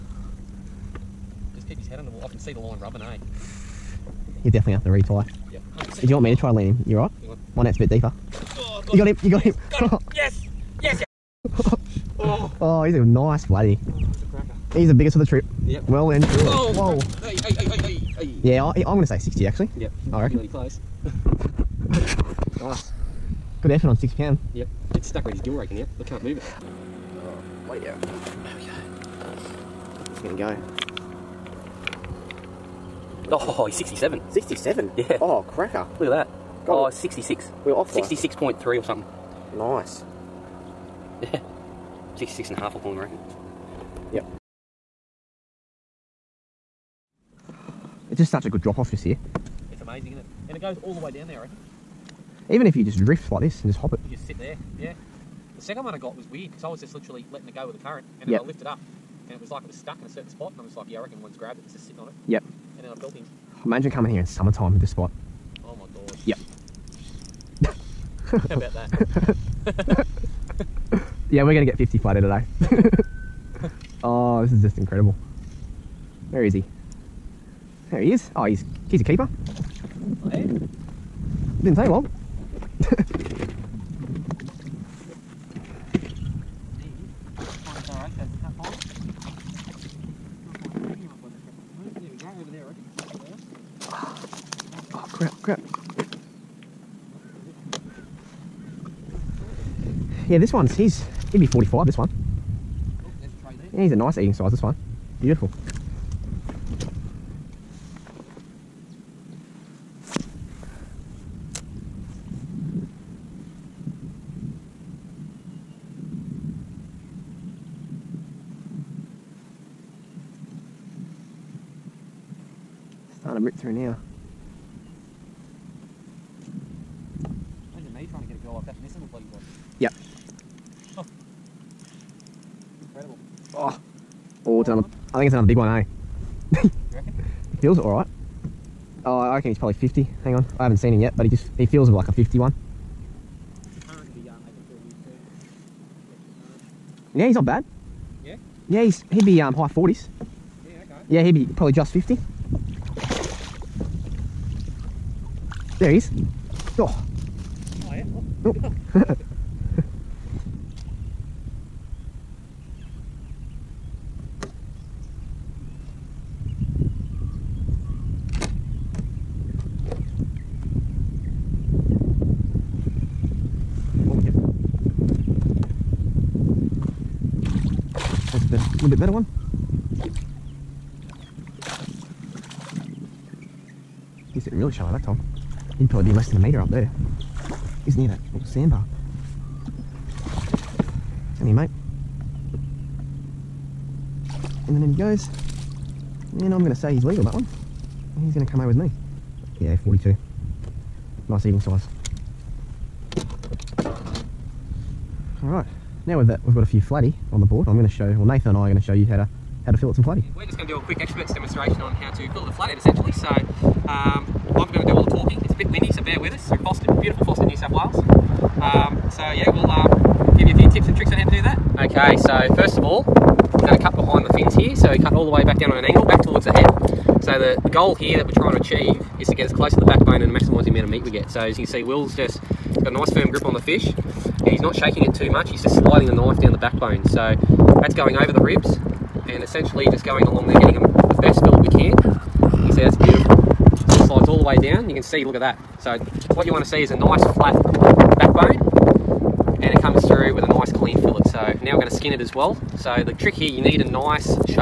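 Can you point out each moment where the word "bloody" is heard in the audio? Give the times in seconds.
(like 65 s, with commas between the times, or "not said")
13 s, 129 s.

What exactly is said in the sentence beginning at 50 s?
And it goes all the way down there, I reckon.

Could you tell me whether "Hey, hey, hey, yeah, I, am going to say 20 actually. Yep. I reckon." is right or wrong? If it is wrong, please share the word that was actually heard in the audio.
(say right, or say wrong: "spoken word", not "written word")
wrong: "60", not "20".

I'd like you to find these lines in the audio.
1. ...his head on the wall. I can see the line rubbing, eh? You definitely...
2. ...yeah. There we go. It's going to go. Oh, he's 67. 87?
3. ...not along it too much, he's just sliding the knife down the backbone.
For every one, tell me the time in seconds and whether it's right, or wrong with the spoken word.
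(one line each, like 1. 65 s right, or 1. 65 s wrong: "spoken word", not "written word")
1. 1 s right
2. 27 s wrong: "67", not "87"
3. 234 s wrong: "shaking", not "along".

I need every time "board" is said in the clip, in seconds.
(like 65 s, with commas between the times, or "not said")
207 s.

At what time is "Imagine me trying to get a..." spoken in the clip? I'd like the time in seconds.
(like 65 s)
127 s.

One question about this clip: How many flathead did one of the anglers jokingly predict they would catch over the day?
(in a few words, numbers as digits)
50.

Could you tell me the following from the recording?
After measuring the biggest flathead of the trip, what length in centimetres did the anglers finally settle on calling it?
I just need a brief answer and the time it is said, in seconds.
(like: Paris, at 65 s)
66.5, at 42 s.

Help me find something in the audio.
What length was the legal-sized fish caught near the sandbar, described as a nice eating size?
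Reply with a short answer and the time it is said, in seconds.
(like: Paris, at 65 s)
42, at 199 s.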